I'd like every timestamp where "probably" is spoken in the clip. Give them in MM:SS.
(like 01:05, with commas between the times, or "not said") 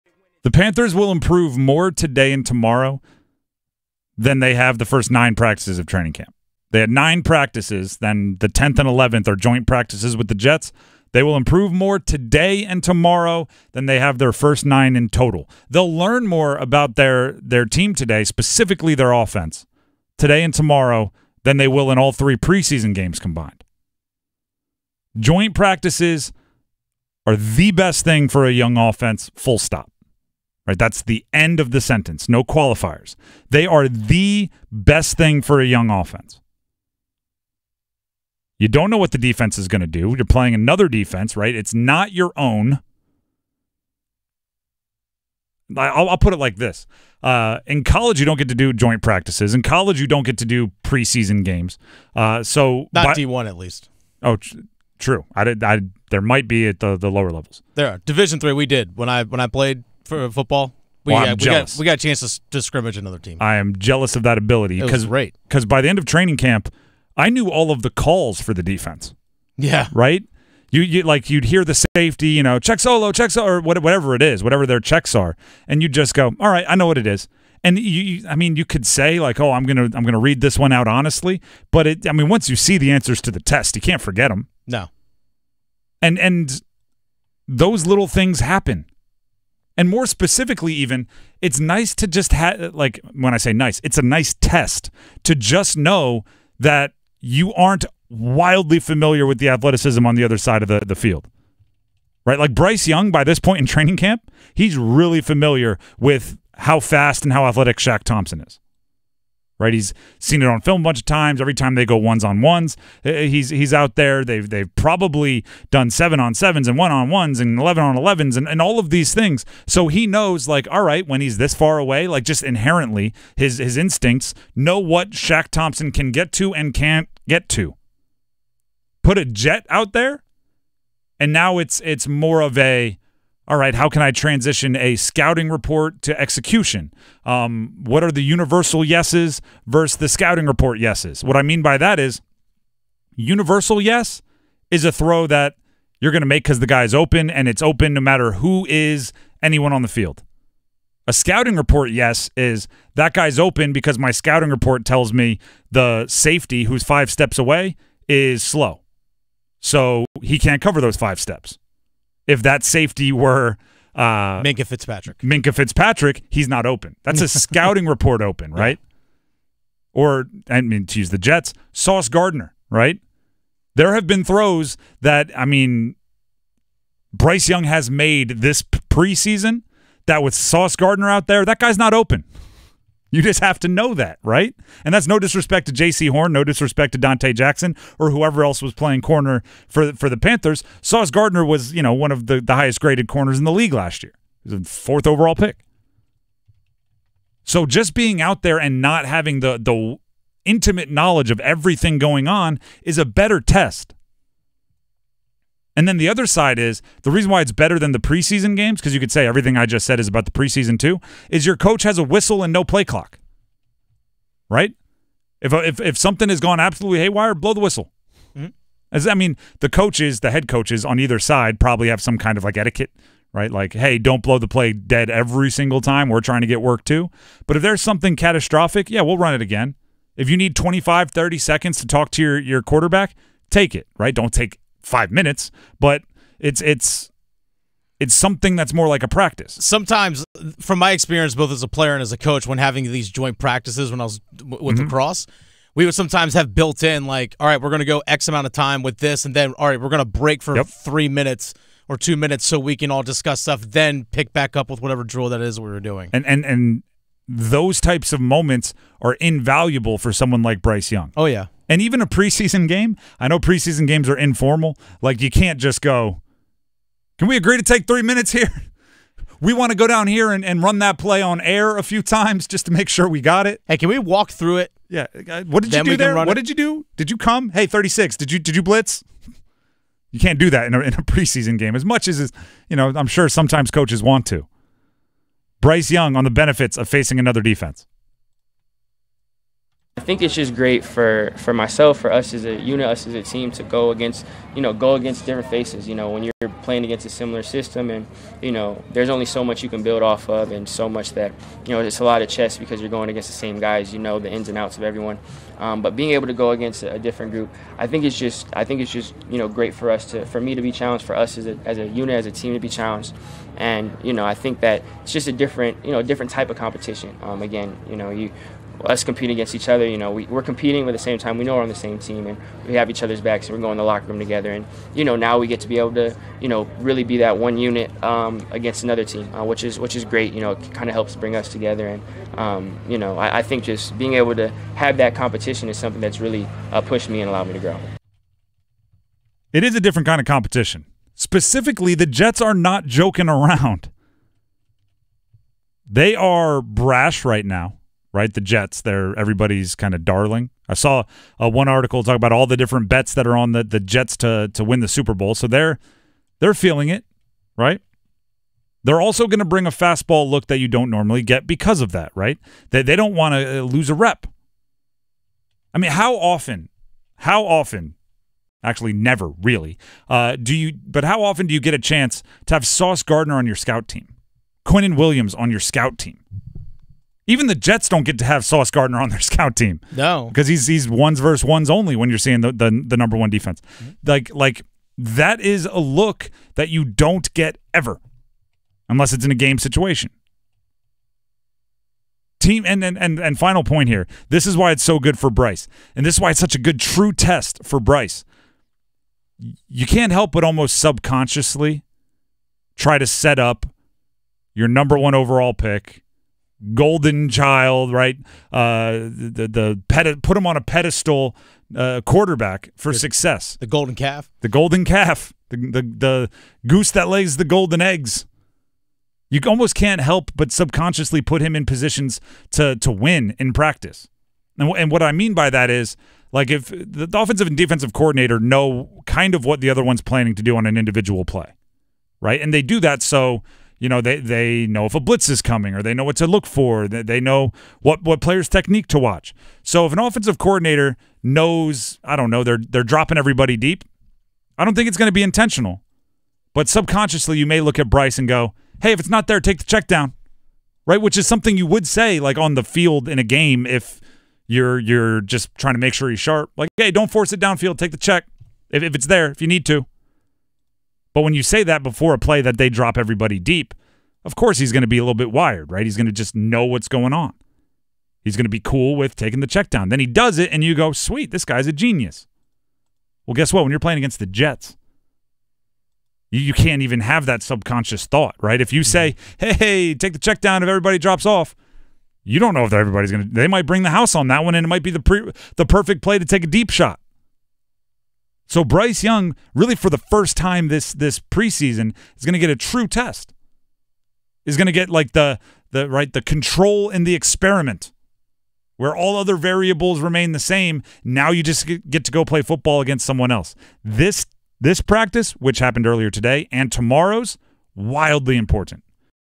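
01:54, 03:41.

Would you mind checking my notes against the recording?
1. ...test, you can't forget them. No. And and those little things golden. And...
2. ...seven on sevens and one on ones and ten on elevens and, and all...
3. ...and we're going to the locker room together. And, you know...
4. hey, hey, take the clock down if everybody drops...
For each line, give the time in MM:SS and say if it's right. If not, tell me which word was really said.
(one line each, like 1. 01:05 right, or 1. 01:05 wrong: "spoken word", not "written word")
1. 01:23 wrong: "happen", not "golden"
2. 01:55 wrong: "eleven", not "ten"
3. 05:23 right
4. 07:59 wrong: "check", not "clock".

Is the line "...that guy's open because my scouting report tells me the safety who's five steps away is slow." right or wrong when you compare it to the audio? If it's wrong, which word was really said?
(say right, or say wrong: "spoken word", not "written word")
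right.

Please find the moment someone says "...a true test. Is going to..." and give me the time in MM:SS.
08:12.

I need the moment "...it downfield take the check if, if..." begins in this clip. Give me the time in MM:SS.
07:37.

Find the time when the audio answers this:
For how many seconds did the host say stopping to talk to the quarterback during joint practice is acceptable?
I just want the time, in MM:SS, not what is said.
03:50.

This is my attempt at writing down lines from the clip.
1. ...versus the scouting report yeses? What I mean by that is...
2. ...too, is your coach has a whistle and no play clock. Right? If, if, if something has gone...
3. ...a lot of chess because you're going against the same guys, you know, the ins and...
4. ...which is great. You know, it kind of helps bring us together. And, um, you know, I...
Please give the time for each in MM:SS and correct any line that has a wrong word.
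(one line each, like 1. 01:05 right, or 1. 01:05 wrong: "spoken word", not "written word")
1. 02:19 right
2. 03:30 right
3. 05:01 right
4. 05:29 right.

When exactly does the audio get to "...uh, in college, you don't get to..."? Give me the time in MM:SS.
00:47.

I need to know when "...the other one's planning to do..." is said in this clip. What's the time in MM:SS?
07:09.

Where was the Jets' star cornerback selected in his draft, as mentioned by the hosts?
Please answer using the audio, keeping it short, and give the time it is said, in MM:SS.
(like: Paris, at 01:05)
Fourth overall, at 03:14.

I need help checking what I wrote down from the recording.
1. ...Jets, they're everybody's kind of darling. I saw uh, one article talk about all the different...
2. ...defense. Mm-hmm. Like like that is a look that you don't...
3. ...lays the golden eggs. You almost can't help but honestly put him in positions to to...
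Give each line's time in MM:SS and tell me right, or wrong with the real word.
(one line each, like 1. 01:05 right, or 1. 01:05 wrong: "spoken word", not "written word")
1. 05:48 right
2. 06:23 right
3. 06:57 wrong: "subconsciously", not "honestly".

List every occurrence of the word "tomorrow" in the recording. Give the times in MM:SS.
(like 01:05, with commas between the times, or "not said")
00:02, 00:12, 00:20, 08:26.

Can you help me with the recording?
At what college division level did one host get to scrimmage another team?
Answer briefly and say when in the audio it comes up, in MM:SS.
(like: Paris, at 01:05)
Division three, at 00:58.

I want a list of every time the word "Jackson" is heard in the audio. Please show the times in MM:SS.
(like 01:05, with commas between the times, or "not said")
03:07.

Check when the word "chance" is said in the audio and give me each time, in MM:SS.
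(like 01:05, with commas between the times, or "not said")
01:01, 06:11.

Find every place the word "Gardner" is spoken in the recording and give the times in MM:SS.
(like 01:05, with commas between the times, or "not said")
02:52, 03:00, 03:11, 06:13, 06:18.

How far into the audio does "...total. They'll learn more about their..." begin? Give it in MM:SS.
00:15.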